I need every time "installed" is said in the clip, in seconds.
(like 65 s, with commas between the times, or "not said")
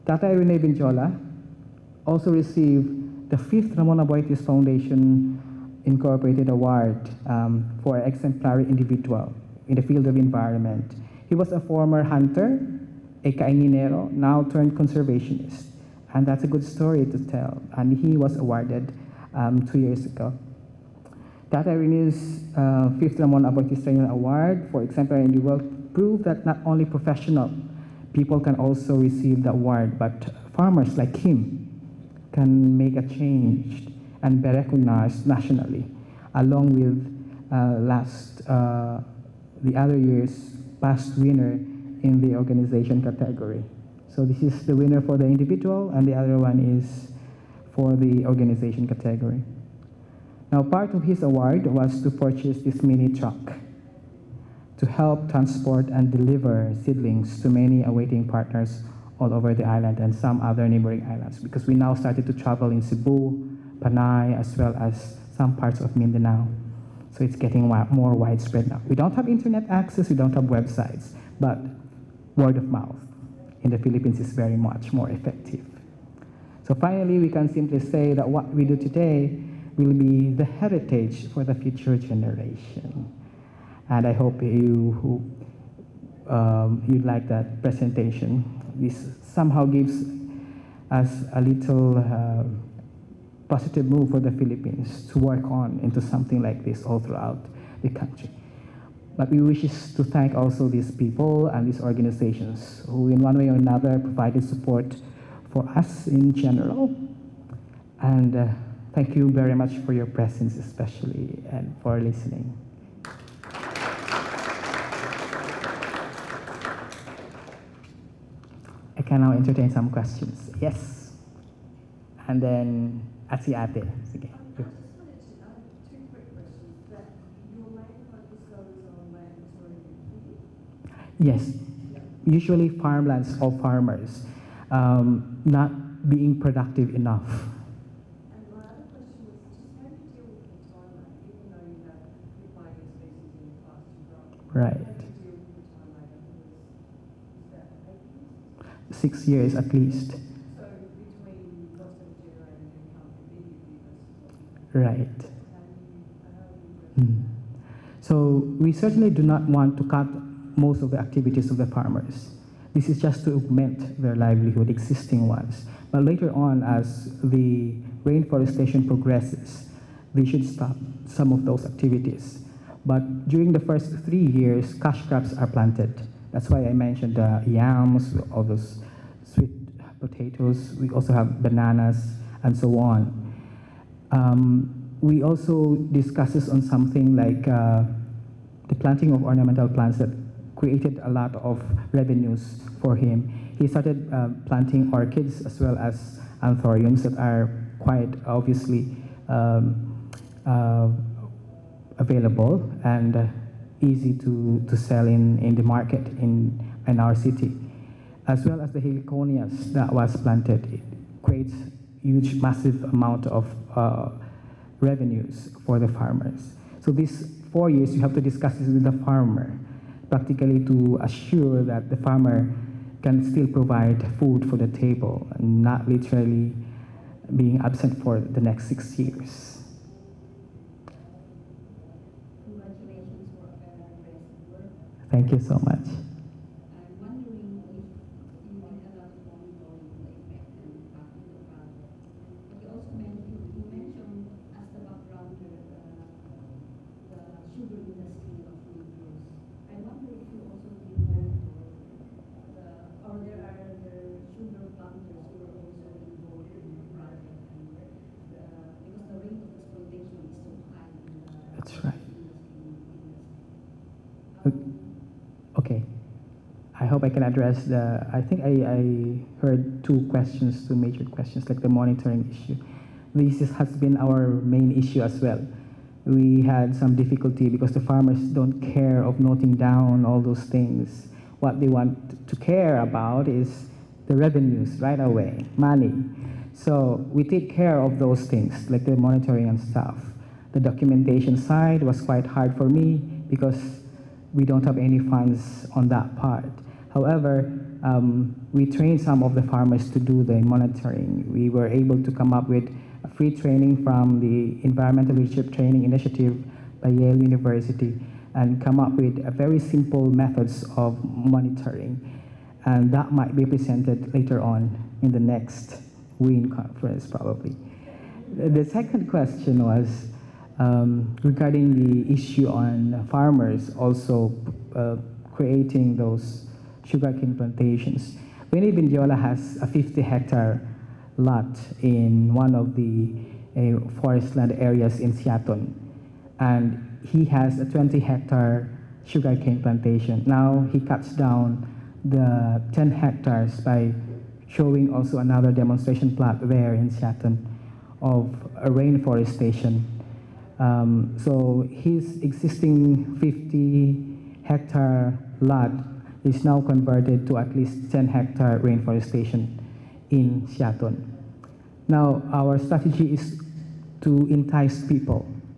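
not said.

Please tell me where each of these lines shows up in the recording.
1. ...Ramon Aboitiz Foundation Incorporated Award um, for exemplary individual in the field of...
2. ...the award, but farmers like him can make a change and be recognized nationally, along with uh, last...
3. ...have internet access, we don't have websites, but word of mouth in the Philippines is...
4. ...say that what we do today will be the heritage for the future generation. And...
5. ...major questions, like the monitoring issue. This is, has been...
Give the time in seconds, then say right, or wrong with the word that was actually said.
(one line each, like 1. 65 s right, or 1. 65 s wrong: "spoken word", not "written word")
1. 3 s right
2. 29 s right
3. 69 s right
4. 77 s right
5. 270 s right.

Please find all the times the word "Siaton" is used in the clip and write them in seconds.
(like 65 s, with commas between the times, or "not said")
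335 s, 346 s, 360 s.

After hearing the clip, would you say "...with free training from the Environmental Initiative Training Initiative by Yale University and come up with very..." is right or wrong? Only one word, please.
wrong.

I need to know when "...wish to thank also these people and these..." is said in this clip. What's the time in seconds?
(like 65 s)
99 s.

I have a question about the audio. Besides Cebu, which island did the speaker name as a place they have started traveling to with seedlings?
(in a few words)
Panay.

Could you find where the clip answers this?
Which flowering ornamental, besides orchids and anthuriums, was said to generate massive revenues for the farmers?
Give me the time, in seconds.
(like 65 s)
208 s.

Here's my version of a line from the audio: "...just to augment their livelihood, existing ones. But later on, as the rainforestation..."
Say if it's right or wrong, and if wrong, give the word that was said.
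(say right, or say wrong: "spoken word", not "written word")
right.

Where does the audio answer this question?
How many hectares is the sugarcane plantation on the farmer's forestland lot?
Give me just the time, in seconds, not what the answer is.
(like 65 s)
337 s.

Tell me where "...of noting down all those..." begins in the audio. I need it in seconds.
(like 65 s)
279 s.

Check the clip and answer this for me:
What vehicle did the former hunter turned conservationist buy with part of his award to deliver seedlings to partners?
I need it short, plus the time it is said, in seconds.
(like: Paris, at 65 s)
mini truck, at 52 s.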